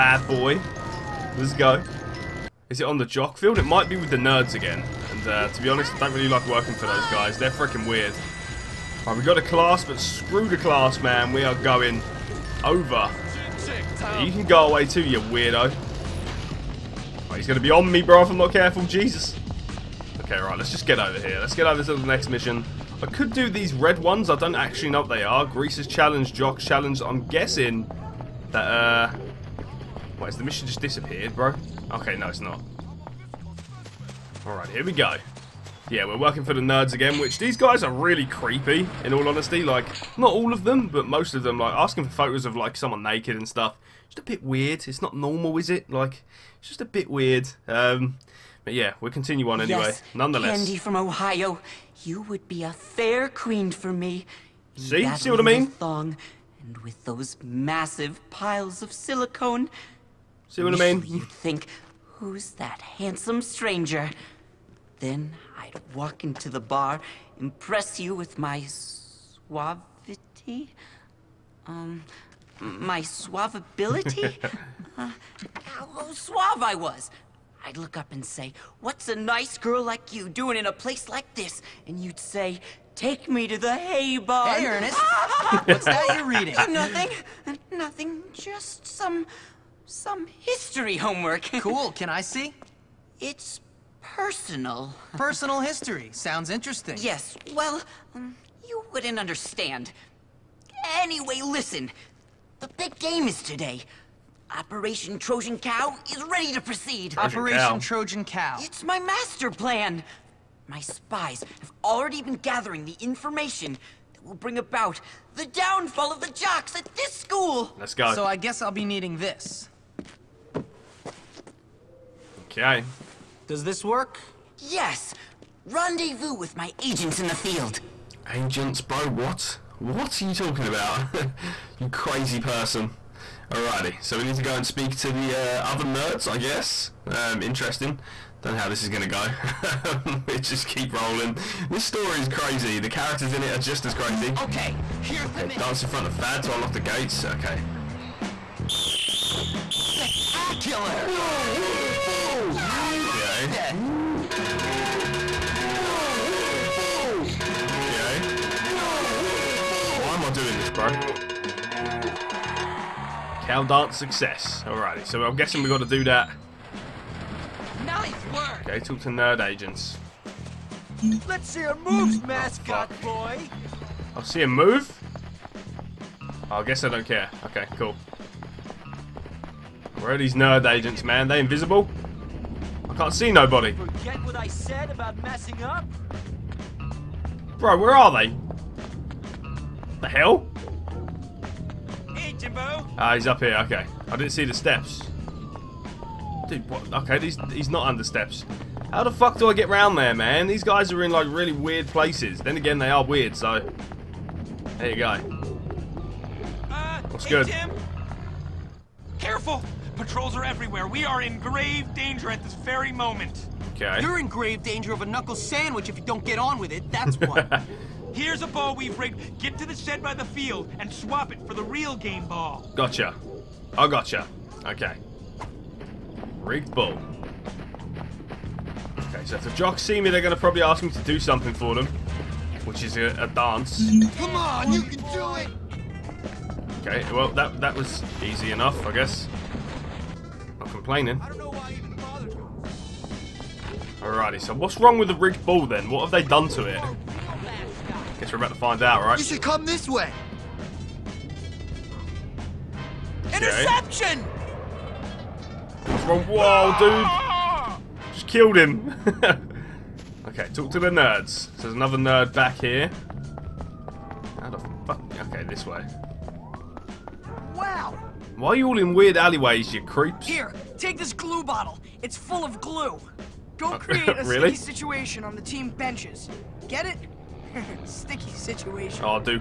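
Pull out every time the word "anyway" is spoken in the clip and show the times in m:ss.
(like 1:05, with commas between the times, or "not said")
0:49, 1:40.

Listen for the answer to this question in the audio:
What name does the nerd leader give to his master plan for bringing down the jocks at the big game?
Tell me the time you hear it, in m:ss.
1:44.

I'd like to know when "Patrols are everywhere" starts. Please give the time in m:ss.
3:29.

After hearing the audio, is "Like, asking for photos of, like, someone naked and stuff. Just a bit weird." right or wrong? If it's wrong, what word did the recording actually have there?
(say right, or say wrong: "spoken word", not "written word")
right.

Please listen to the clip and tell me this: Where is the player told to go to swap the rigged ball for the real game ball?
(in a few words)
the shed by the field.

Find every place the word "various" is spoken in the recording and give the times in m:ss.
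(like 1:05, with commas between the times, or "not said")
not said.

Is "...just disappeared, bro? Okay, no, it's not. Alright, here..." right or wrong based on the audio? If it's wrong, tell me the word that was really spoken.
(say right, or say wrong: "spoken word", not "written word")
right.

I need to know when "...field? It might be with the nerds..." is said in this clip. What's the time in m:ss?
0:03.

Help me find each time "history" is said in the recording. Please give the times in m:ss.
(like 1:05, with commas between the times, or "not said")
1:30, 1:35.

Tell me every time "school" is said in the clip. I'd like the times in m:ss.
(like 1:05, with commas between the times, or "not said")
1:57.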